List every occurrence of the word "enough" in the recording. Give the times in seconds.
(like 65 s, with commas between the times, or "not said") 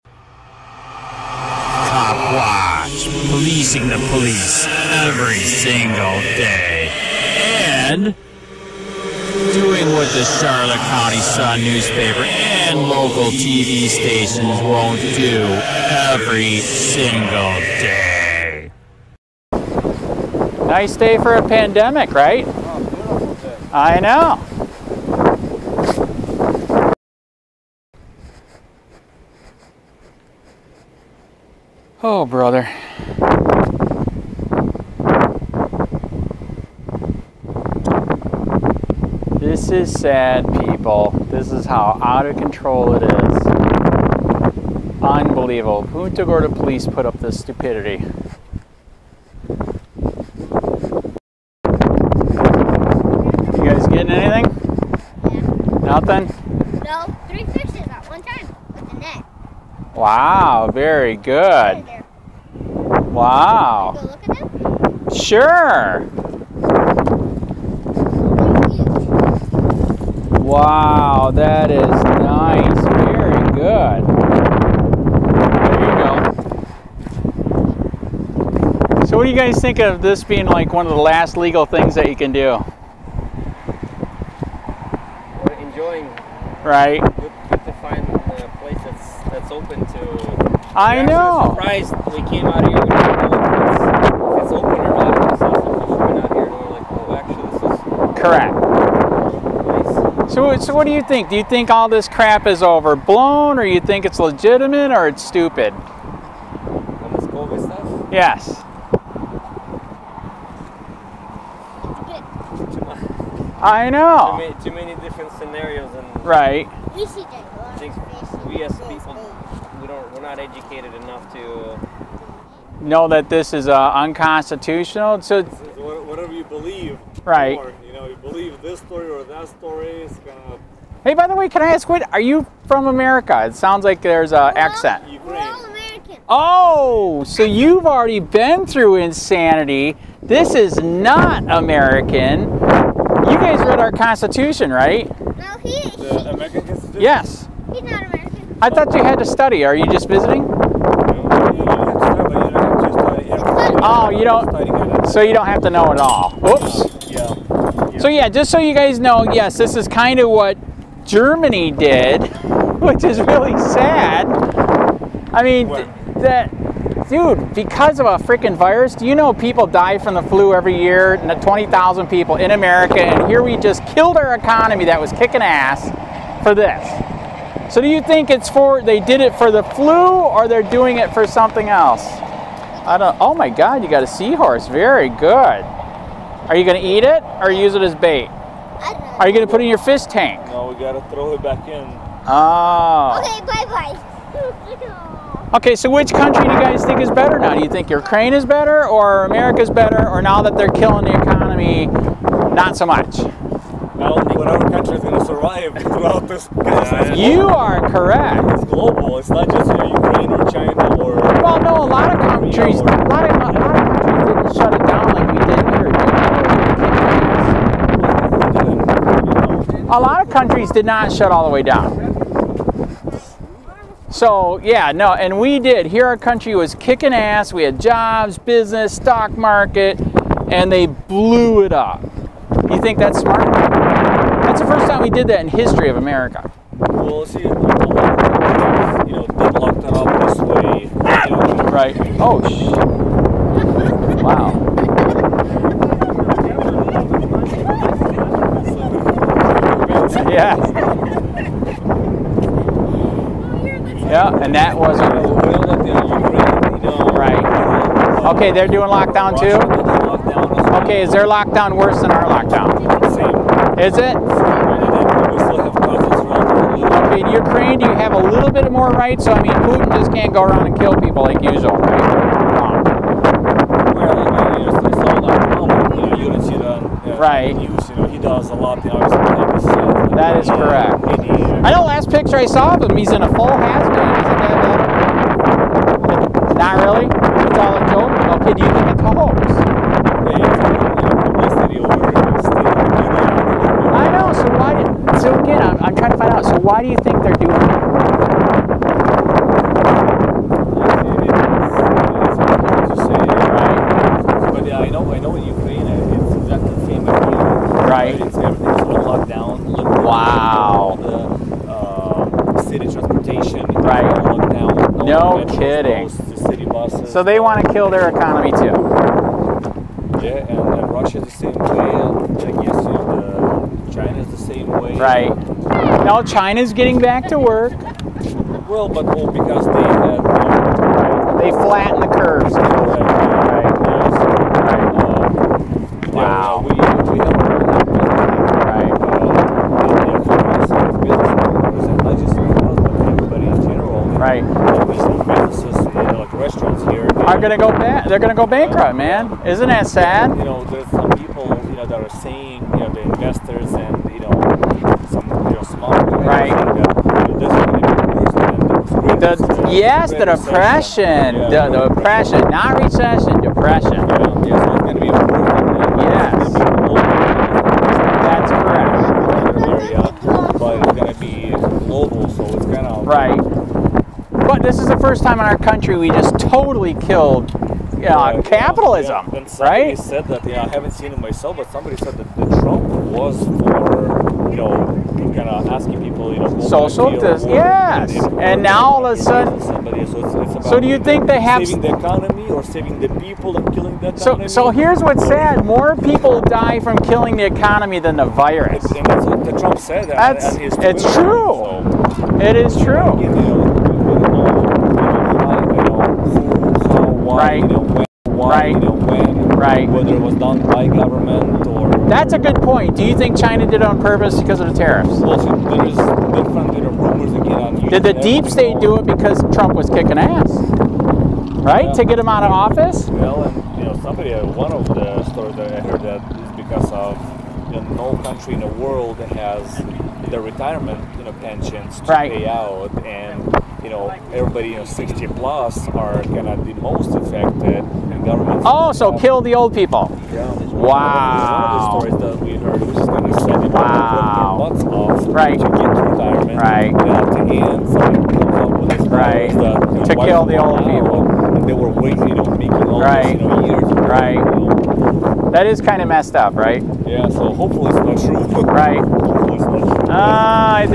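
120 s.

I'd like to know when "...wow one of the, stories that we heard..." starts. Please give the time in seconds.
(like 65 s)
440 s.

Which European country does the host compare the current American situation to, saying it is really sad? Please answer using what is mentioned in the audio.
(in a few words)
Germany.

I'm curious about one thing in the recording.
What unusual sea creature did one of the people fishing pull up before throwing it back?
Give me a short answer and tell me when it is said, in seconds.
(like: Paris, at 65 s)
seahorse, at 184 s.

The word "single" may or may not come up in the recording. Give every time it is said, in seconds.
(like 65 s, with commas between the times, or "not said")
5 s, 16 s.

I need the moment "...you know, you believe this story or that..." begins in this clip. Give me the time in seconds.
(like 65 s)
127 s.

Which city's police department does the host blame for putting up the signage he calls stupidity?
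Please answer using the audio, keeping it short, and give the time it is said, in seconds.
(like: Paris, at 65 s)
Punta Gorda, at 45 s.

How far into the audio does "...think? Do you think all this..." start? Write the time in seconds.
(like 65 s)
101 s.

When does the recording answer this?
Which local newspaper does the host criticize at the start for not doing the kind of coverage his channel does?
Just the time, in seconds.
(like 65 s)
10 s.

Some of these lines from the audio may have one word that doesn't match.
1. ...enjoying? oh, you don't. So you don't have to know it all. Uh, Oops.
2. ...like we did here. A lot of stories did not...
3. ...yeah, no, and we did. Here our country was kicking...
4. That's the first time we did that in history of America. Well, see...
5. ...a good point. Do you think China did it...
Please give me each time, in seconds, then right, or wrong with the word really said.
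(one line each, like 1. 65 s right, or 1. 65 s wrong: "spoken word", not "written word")
1. 150 s wrong: "visiting", not "enjoying"
2. 215 s wrong: "countries", not "stories"
3. 224 s right
4. 233 s right
5. 412 s right.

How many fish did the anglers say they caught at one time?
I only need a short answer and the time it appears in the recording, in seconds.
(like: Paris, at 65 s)
3, at 57 s.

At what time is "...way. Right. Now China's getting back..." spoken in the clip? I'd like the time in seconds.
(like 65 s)
324 s.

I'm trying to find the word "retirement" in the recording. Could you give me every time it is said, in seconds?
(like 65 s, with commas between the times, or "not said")
430 s.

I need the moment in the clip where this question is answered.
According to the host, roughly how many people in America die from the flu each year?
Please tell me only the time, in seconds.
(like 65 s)
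171 s.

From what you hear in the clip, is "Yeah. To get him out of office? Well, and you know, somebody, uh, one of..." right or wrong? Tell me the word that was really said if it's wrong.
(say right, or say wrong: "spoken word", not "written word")
right.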